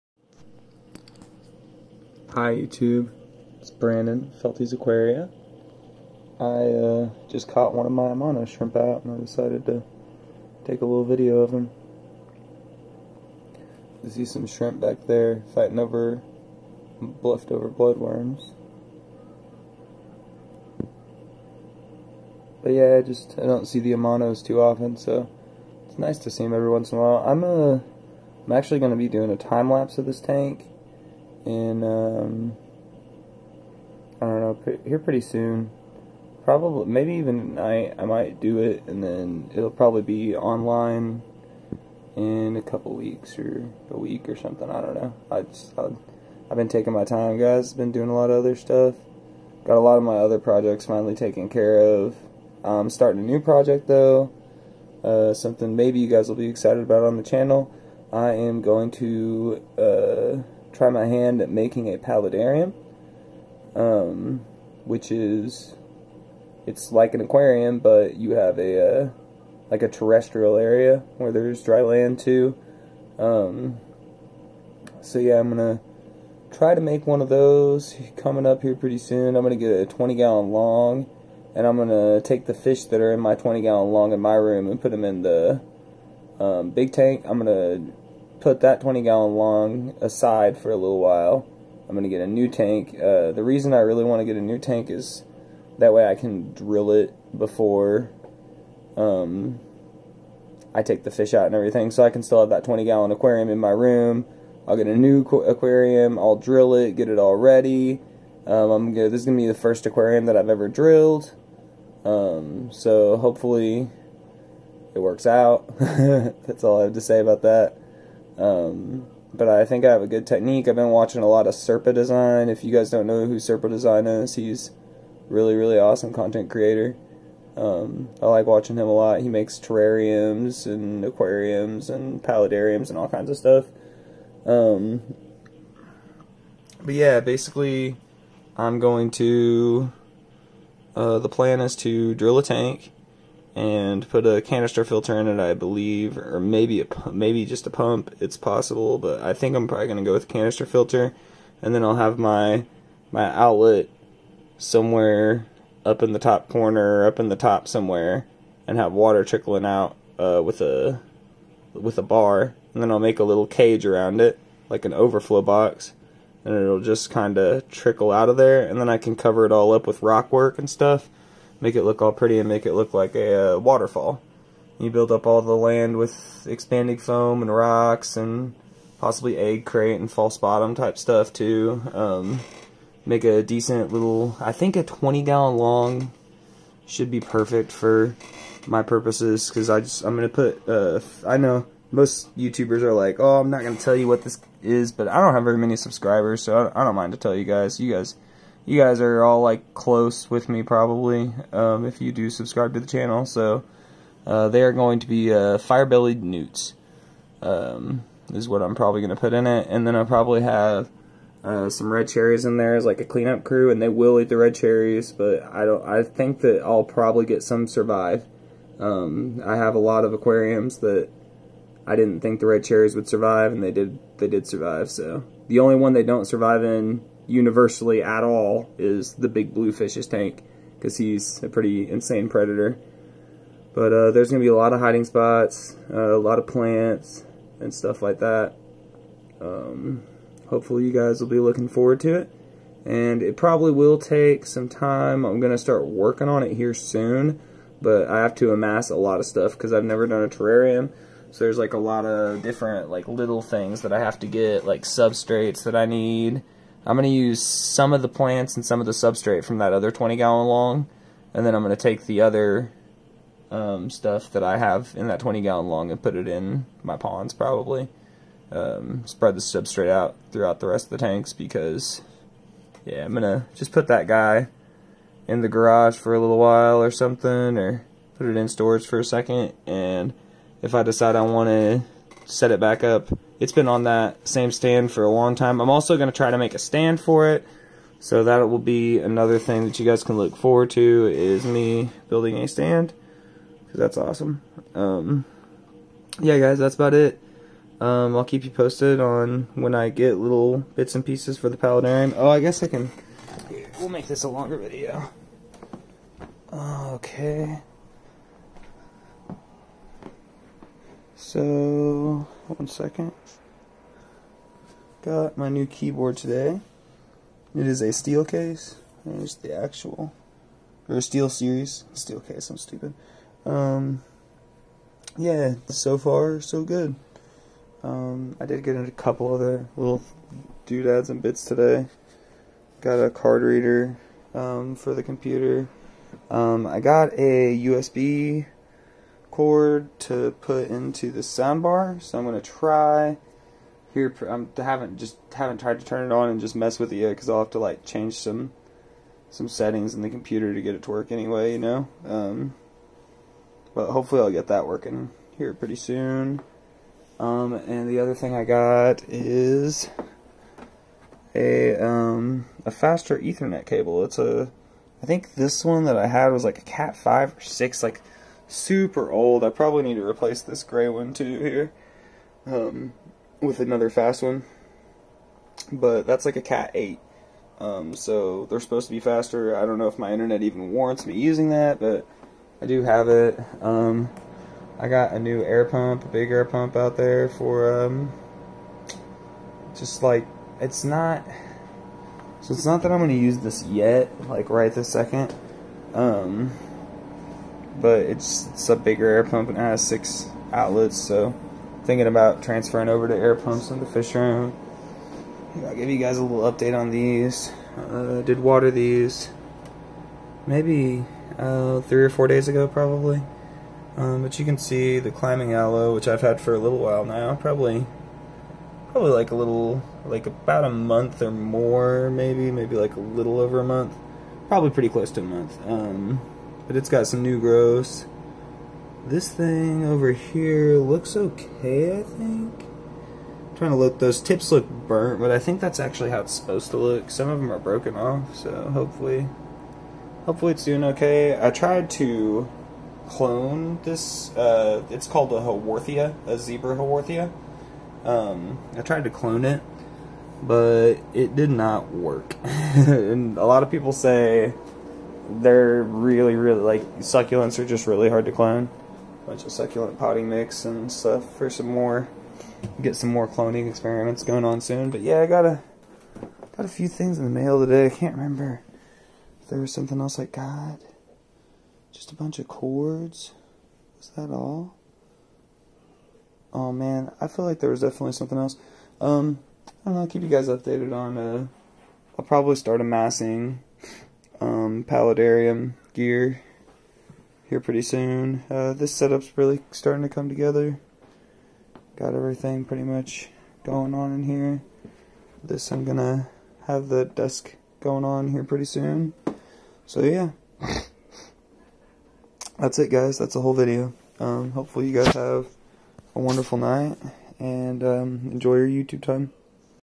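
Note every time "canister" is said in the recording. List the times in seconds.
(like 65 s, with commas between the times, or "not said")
144 s, 150 s.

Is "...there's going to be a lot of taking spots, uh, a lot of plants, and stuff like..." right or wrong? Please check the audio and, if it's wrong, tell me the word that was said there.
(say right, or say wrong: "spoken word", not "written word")
wrong: "hiding", not "taking".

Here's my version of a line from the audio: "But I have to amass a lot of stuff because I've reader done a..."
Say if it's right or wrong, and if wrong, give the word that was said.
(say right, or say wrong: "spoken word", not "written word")
wrong: "never", not "reader".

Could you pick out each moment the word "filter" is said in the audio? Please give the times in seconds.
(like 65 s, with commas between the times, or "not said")
144 s, 150 s.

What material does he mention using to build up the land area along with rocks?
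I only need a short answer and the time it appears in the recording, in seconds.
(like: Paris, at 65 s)
expanding foam, at 176 s.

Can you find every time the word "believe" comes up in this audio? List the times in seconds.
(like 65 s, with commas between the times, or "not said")
145 s.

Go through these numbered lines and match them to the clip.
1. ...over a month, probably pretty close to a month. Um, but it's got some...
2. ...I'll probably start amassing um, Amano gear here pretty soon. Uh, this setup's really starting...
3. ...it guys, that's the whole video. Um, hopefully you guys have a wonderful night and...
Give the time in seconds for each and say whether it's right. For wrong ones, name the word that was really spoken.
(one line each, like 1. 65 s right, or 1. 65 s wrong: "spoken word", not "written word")
1. 423 s right
2. 482 s wrong: "Paludarium", not "Amano"
3. 502 s right.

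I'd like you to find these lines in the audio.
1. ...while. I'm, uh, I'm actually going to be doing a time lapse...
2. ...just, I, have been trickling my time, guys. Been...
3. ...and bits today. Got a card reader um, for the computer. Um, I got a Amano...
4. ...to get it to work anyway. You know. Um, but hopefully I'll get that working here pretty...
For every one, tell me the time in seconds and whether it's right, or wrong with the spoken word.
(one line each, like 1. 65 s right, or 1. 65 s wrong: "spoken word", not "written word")
1. 27 s right
2. 45 s wrong: "taking", not "trickling"
3. 331 s wrong: "USB", not "Amano"
4. 350 s right.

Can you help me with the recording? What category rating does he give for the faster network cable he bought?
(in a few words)
Cat 8.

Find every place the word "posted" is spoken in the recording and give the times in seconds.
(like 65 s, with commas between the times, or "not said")
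298 s.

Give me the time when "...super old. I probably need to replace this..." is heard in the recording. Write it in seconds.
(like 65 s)
368 s.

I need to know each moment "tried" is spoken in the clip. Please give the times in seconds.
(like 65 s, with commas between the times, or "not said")
345 s, 441 s, 448 s.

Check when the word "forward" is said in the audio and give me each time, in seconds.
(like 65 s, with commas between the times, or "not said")
241 s, 290 s.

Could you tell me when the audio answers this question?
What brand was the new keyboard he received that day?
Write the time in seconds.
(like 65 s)
320 s.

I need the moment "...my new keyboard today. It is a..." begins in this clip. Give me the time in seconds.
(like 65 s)
315 s.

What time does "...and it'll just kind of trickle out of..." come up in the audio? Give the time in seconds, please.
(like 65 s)
166 s.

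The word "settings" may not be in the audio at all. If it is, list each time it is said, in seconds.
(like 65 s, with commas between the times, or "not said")
349 s.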